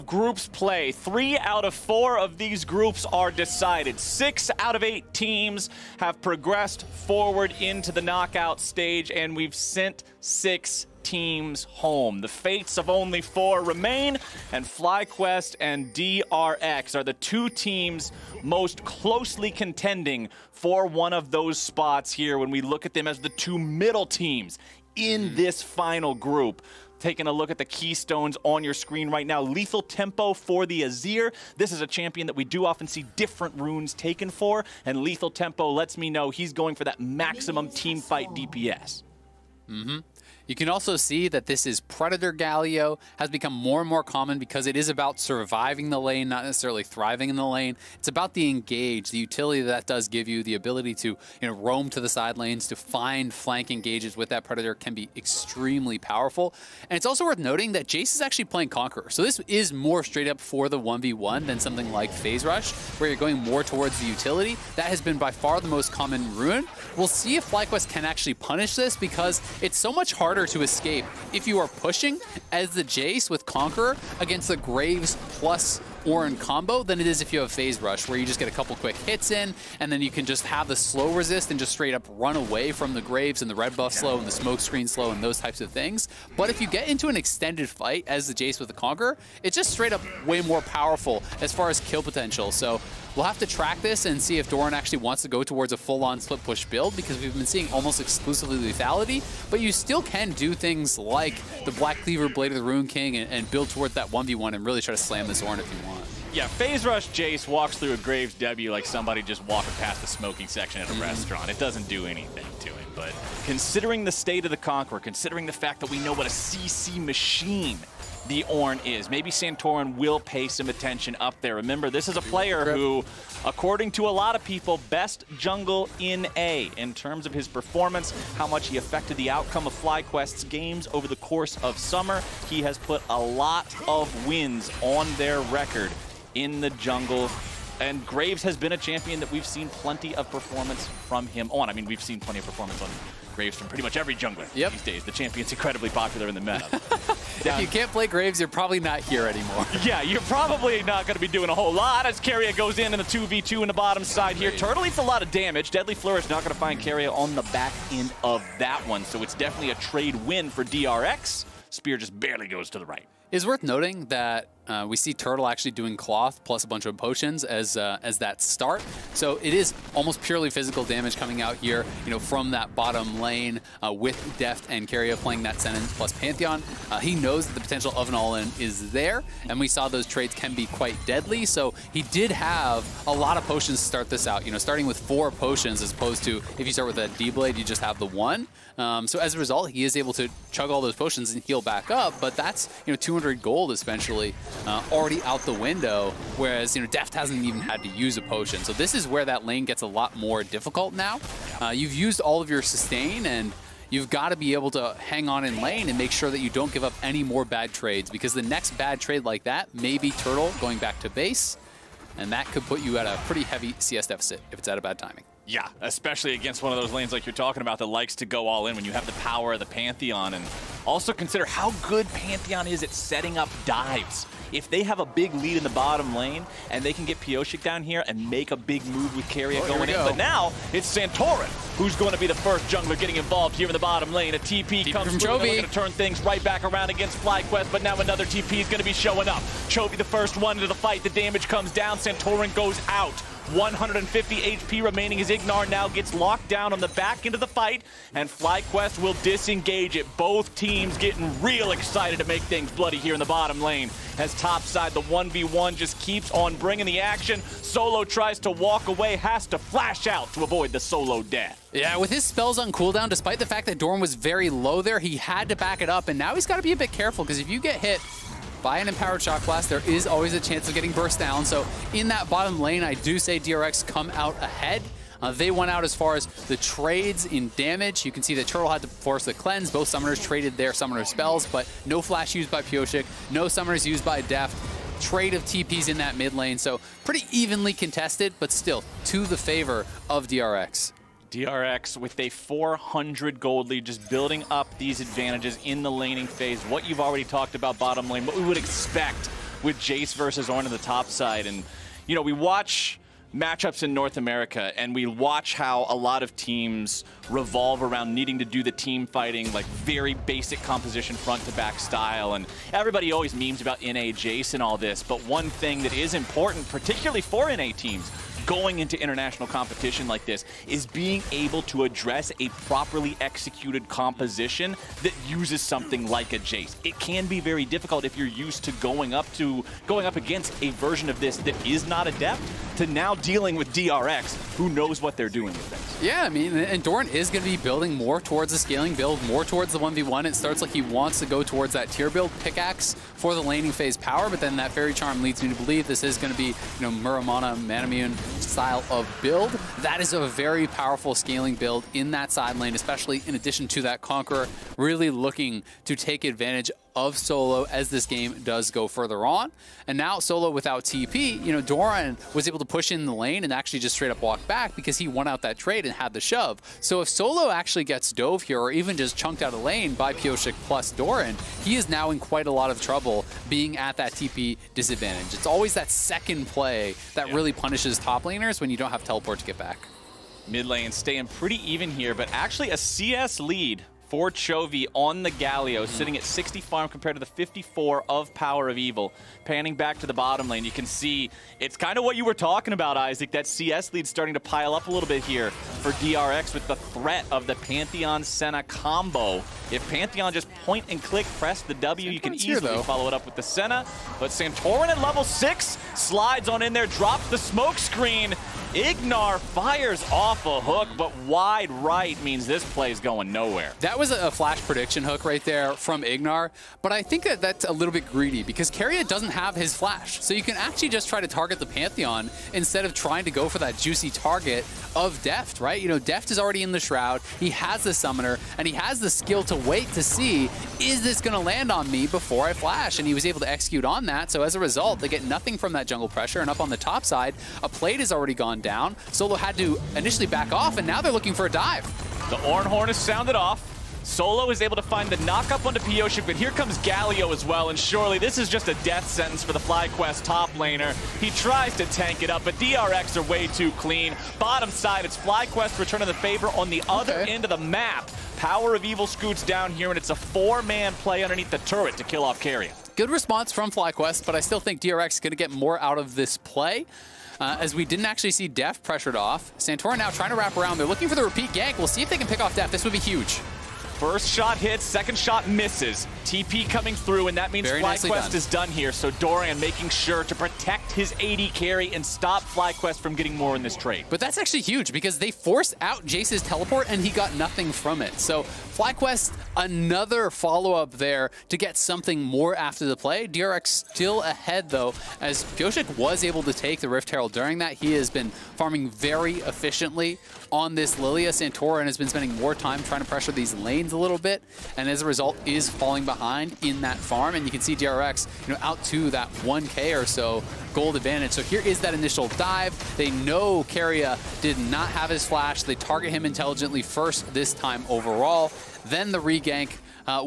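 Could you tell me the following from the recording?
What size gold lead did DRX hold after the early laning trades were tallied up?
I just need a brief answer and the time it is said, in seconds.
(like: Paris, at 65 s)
400 gold, at 292 s.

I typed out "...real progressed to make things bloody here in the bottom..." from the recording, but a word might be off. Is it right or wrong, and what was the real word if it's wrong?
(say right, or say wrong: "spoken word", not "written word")
wrong: "excited", not "progressed".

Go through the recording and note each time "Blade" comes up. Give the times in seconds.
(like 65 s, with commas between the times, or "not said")
102 s, 187 s.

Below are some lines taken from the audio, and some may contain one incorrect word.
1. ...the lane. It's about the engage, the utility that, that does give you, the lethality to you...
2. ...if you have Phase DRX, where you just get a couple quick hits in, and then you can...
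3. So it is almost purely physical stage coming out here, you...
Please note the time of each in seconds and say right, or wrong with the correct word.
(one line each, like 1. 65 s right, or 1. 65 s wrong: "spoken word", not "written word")
1. 47 s wrong: "ability", not "lethality"
2. 77 s wrong: "Rush", not "DRX"
3. 169 s wrong: "damage", not "stage".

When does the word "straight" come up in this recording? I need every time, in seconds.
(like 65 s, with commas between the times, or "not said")
60 s, 81 s, 89 s, 363 s.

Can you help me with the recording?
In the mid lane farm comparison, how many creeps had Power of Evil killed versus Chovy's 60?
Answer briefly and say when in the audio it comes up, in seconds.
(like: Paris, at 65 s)
54, at 387 s.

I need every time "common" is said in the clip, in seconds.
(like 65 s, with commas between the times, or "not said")
44 s, 65 s.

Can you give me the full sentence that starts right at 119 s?
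Maybe Santorin will pay some attention up there.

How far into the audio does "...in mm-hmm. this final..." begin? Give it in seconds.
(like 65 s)
24 s.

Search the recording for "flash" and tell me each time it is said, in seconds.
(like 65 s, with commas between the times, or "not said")
259 s, 281 s, 414 s, 419 s, 432 s, 515 s.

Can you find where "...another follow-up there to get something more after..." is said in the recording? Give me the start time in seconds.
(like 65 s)
489 s.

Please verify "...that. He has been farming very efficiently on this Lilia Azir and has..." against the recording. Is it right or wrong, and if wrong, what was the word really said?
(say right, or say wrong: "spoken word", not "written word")
wrong: "Santorin", not "Azir".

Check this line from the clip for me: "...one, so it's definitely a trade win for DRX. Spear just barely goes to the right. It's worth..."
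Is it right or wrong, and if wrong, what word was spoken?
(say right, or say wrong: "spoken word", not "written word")
right.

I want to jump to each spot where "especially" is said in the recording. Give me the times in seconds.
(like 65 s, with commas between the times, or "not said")
215 s, 352 s.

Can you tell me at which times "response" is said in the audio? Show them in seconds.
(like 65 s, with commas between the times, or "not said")
463 s.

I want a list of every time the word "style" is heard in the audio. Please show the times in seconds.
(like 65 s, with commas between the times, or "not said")
311 s, 348 s.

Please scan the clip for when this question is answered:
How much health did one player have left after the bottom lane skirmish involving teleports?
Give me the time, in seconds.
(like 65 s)
243 s.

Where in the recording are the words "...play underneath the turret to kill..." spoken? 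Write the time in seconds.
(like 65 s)
460 s.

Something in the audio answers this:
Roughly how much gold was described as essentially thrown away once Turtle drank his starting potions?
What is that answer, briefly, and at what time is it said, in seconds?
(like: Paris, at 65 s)
200 gold, at 192 s.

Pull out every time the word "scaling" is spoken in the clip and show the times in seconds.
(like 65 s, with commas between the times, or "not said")
338 s, 351 s.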